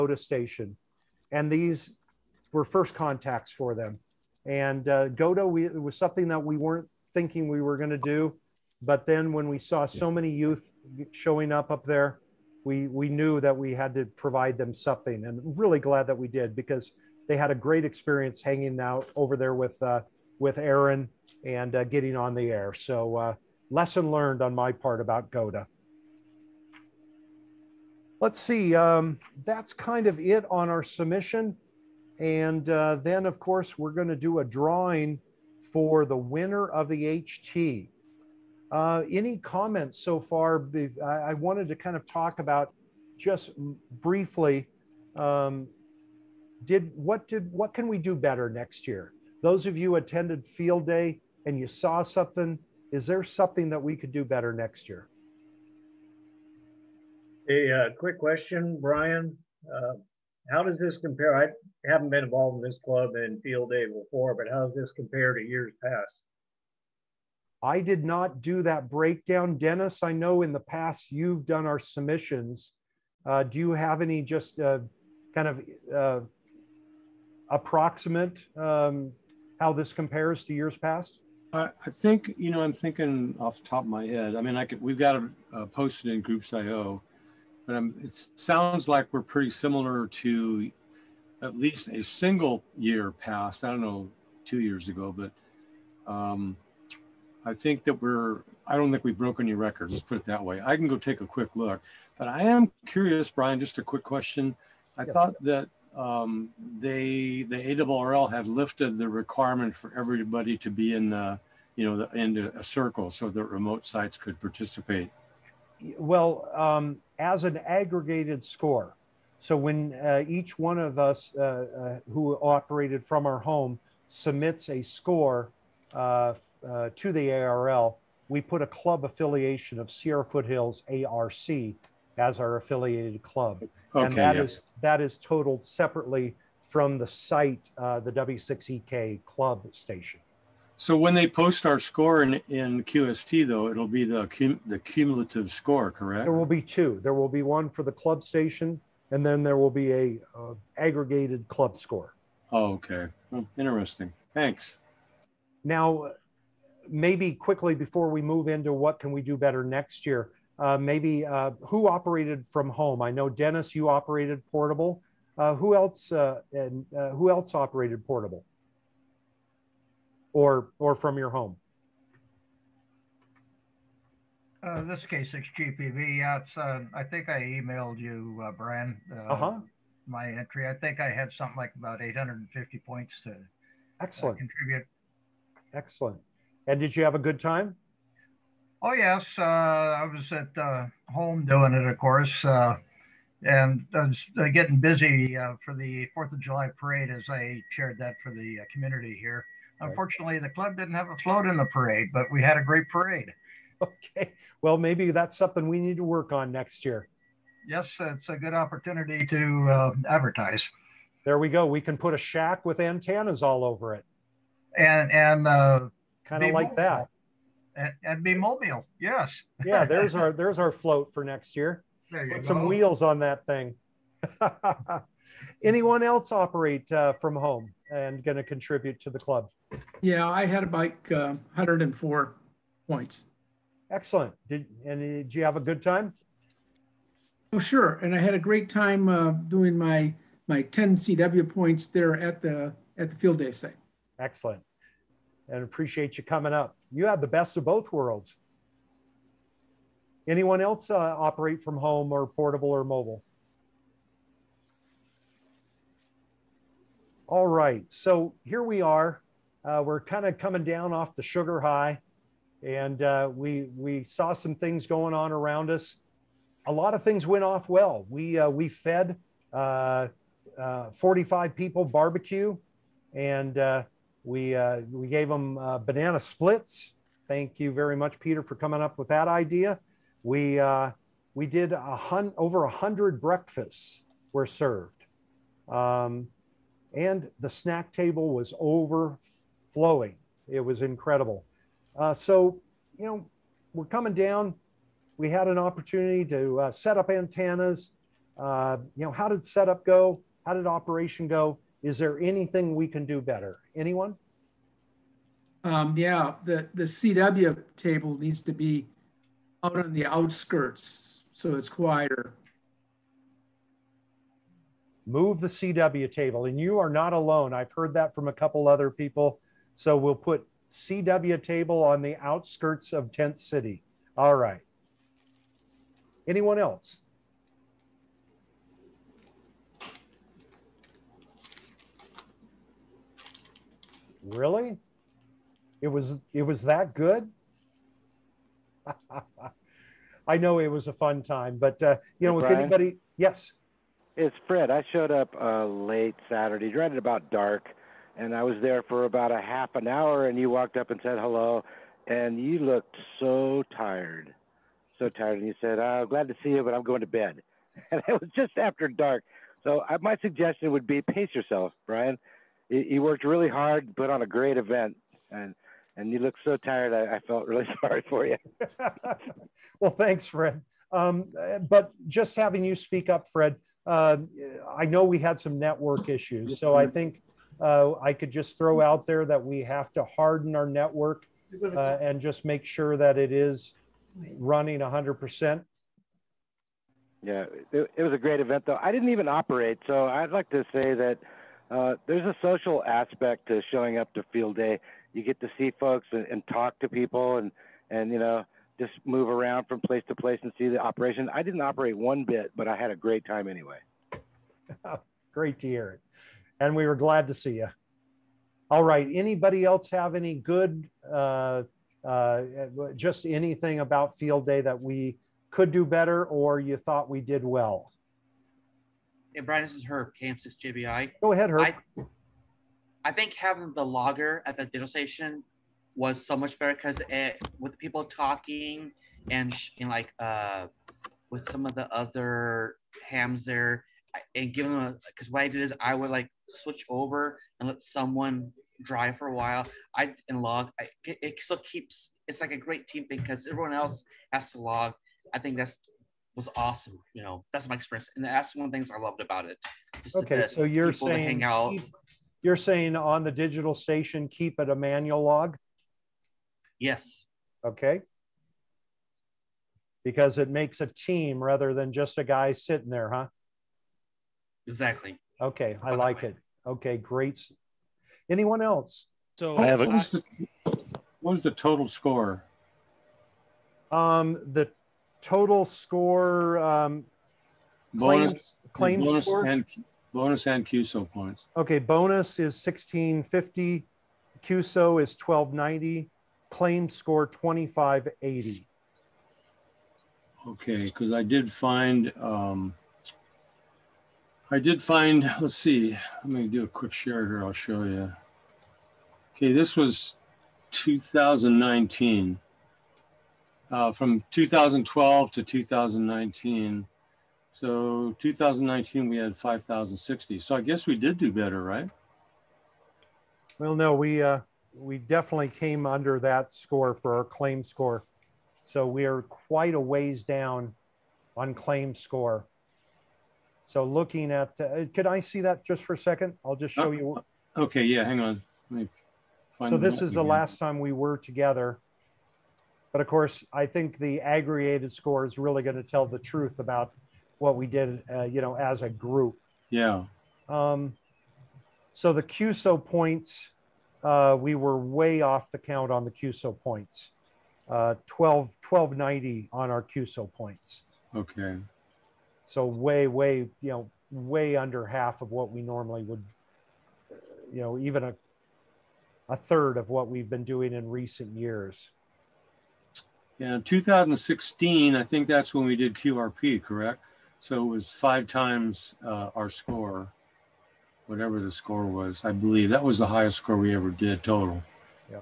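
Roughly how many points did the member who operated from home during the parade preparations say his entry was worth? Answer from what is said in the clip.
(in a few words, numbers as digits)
850.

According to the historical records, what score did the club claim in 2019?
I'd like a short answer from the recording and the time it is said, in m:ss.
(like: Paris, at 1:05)
5,060, at 8:29.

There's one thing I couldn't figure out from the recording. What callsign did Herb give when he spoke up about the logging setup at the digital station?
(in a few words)
KM6JBI.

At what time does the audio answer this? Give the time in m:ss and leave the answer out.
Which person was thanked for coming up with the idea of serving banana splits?
4:38.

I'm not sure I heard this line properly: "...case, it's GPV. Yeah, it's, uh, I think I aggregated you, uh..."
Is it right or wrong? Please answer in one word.
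wrong.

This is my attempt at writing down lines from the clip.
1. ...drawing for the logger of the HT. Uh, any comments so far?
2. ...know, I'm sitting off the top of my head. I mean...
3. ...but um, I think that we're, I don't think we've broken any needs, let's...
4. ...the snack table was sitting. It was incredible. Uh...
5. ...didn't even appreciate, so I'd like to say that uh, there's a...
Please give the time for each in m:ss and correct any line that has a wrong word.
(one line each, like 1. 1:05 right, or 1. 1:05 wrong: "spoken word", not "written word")
1. 0:34 wrong: "winner", not "logger"
2. 1:22 wrong: "thinking", not "sitting"
3. 1:35 wrong: "records", not "needs"
4. 4:47 wrong: "overflowing", not "sitting"
5. 6:28 wrong: "operate", not "appreciate".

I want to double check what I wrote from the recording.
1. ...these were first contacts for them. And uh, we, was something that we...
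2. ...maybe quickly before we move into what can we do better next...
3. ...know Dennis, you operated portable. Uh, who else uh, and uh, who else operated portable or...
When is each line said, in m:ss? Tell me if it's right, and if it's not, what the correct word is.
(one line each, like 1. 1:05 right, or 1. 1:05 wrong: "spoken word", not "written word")
1. 0:01 right
2. 2:36 right
3. 2:43 right.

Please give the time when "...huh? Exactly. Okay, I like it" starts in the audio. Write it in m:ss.
7:43.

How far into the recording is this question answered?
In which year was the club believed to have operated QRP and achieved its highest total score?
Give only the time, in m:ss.
9:23.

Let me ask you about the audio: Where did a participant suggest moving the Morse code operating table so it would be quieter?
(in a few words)
the outskirts of Tent City.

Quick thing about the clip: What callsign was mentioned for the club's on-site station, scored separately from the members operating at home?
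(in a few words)
W6EK.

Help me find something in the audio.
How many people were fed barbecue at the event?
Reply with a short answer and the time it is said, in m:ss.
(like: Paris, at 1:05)
45, at 4:30.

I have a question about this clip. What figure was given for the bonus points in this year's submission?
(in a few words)
1650.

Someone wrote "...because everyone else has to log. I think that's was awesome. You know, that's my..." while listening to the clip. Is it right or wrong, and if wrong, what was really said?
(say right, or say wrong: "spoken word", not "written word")
right.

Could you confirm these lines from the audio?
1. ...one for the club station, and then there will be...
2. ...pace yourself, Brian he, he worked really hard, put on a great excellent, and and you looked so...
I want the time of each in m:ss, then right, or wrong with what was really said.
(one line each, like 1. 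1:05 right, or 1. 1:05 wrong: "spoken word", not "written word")
1. 2:27 right
2. 6:01 wrong: "event", not "excellent".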